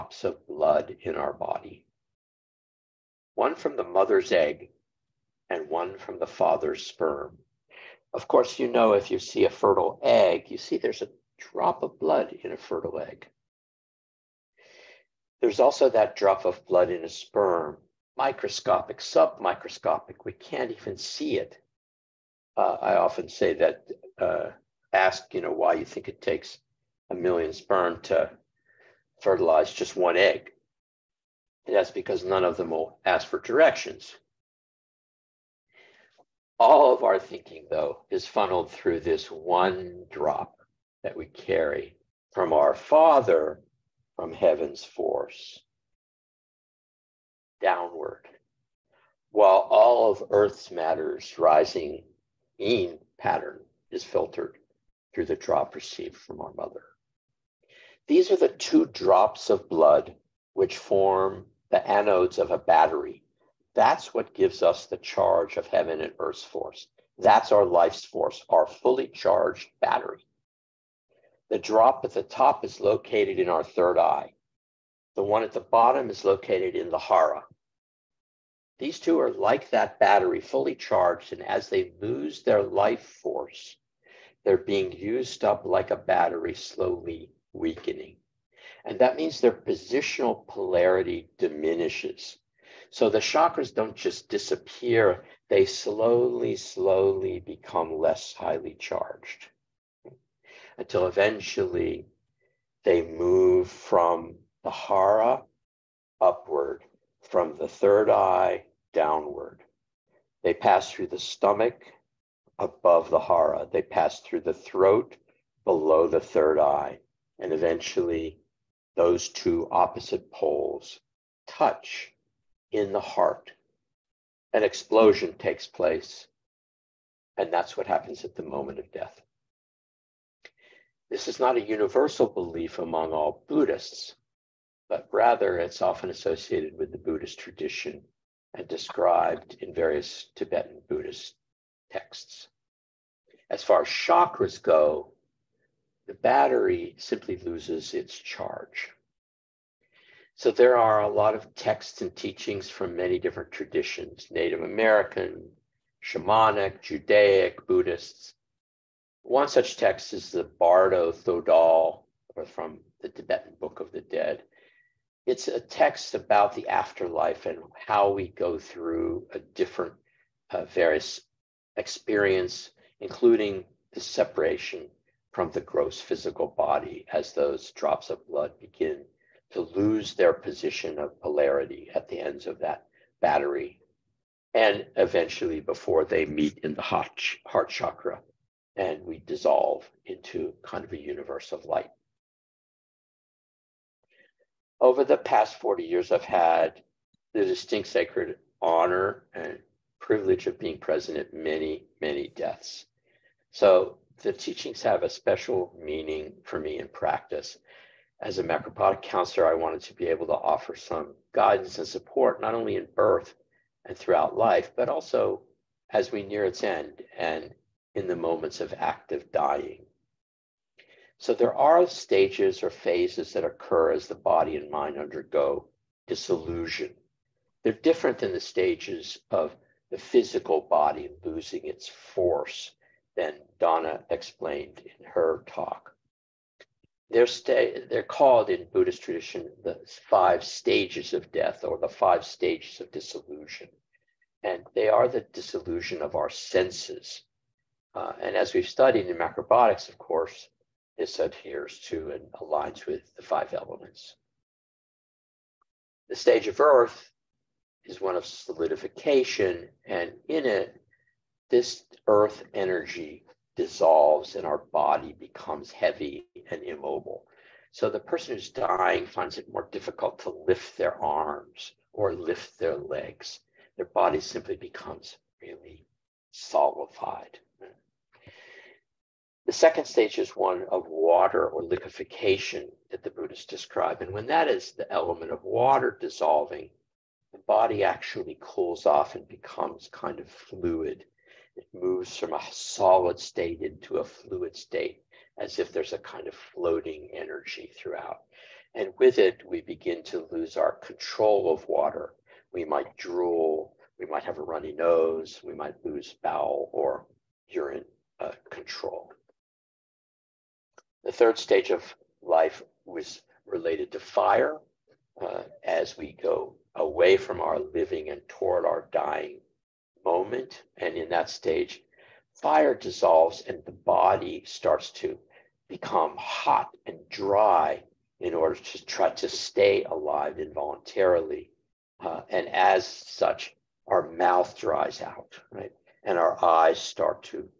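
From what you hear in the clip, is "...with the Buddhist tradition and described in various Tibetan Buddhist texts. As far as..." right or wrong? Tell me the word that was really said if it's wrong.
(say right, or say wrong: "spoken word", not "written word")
right.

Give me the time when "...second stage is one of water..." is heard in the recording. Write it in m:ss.
4:39.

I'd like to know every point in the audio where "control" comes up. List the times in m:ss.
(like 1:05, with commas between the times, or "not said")
5:00, 5:08.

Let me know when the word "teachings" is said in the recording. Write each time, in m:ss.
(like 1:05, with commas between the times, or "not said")
2:32, 3:24.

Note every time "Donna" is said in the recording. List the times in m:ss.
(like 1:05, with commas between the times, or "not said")
3:53.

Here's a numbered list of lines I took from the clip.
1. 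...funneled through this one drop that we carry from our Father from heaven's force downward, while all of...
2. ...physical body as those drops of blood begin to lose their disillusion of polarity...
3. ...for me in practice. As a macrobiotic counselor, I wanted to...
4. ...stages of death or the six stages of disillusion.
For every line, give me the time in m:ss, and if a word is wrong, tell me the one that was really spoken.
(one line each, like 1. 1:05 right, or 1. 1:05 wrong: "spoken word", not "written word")
1. 0:38 right
2. 2:55 wrong: "position", not "disillusion"
3. 3:26 right
4. 4:00 wrong: "five", not "six".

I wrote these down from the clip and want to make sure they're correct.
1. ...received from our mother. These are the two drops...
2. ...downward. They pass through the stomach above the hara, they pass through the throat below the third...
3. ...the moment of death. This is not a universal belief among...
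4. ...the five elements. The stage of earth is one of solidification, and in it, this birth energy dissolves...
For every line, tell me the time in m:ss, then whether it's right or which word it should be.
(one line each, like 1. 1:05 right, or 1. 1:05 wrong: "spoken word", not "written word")
1. 0:55 right
2. 1:48 right
3. 2:08 right
4. 4:13 wrong: "earth", not "birth".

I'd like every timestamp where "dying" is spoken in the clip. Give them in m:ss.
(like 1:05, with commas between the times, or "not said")
3:39, 4:28, 5:18.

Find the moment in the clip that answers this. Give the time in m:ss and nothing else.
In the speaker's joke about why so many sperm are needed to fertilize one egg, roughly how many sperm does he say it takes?
0:27.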